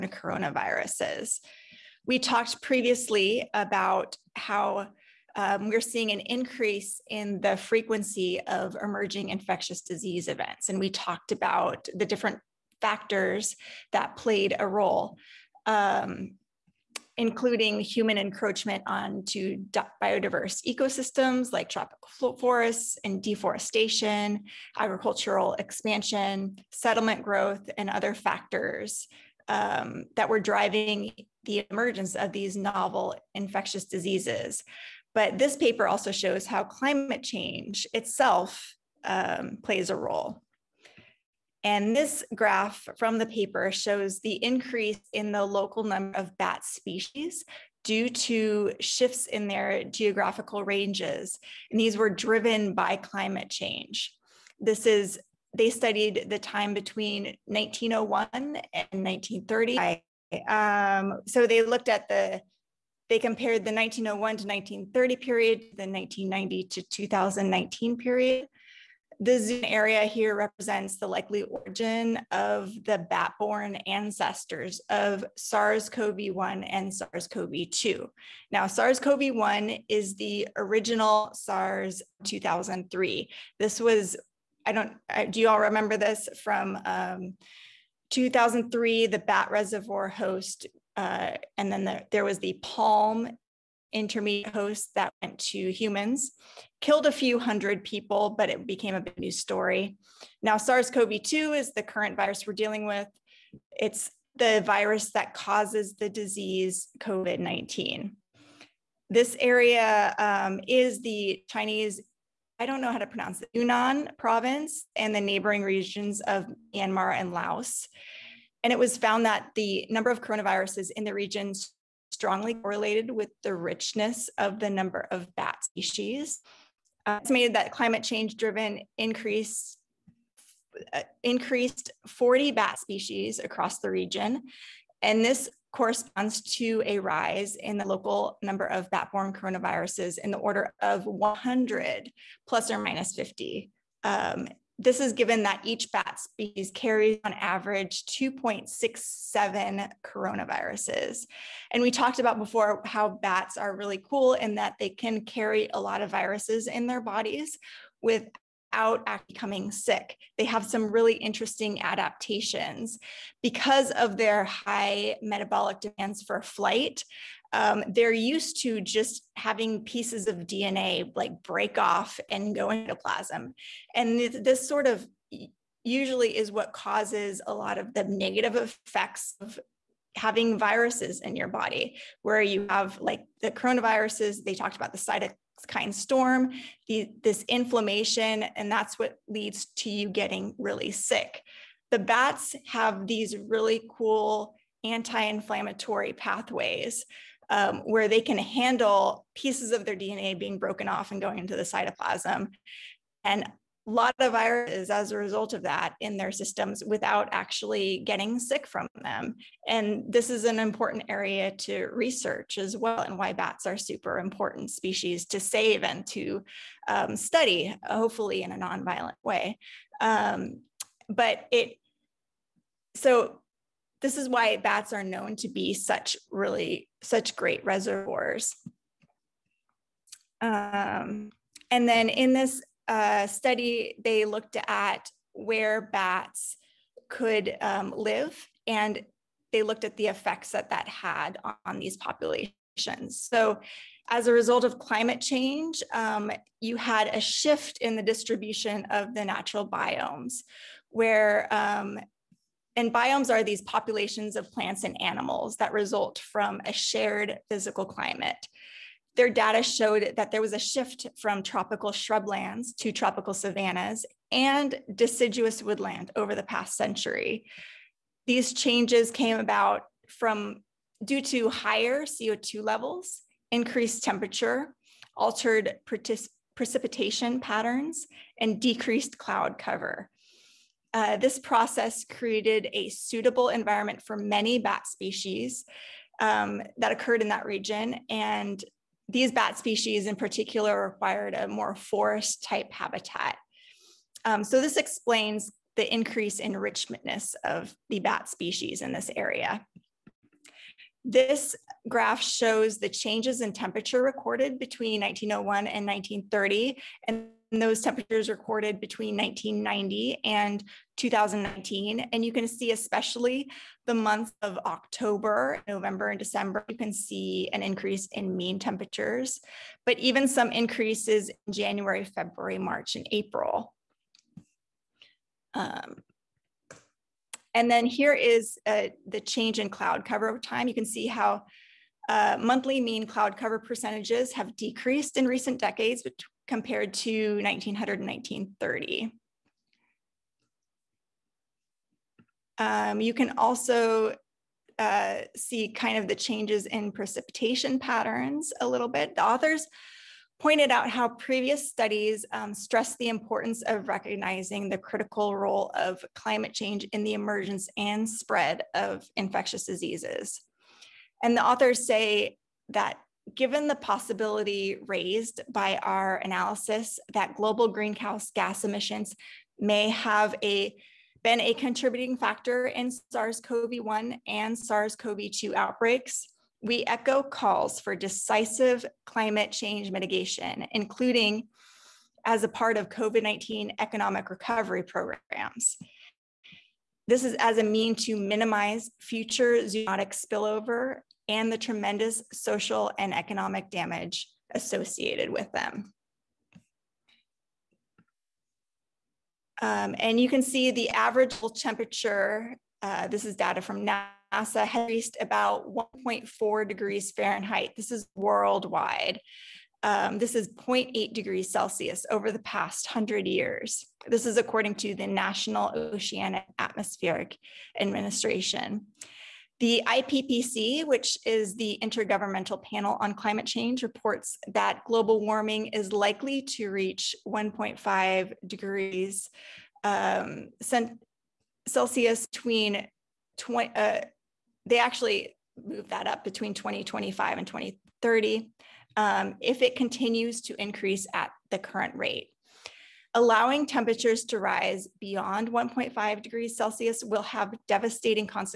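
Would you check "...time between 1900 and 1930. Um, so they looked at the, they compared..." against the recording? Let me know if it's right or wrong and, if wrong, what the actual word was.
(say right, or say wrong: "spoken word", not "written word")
wrong: "1901", not "1900".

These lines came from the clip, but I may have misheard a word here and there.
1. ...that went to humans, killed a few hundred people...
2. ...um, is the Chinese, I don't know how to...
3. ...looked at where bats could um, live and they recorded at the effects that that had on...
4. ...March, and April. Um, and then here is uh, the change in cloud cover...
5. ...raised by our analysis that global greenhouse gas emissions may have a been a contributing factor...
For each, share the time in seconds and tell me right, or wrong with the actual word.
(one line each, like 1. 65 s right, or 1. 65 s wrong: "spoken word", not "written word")
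1. 94 s right
2. 110 s right
3. 234 s wrong: "looked", not "recorded"
4. 322 s right
5. 364 s right.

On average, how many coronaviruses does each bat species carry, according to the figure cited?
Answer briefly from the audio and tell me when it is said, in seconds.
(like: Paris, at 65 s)
2.67, at 148 s.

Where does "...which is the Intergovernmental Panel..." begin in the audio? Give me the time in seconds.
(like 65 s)
420 s.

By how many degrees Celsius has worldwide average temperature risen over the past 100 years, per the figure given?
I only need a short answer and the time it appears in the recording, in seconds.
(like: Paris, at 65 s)
0.8, at 410 s.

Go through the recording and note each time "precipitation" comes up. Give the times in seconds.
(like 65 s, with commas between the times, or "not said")
276 s, 346 s.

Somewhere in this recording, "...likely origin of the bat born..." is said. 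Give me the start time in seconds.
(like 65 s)
71 s.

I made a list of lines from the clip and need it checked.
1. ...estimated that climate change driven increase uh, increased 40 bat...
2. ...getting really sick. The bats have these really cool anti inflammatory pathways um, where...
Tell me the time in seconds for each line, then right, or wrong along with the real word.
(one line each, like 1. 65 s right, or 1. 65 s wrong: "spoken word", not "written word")
1. 127 s right
2. 190 s right.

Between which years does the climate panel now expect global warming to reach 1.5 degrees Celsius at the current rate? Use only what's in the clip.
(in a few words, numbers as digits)
2025 and 2030.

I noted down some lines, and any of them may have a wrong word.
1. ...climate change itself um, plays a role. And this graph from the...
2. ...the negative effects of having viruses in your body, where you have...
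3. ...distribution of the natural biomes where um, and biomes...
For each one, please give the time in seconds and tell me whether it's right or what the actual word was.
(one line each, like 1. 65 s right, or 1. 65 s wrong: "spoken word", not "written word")
1. 36 s right
2. 177 s right
3. 248 s right.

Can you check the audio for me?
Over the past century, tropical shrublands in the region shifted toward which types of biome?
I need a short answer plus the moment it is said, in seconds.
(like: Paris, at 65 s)
Tropical savannas and deciduous woodland, at 262 s.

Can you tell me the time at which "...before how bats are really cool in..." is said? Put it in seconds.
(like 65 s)
152 s.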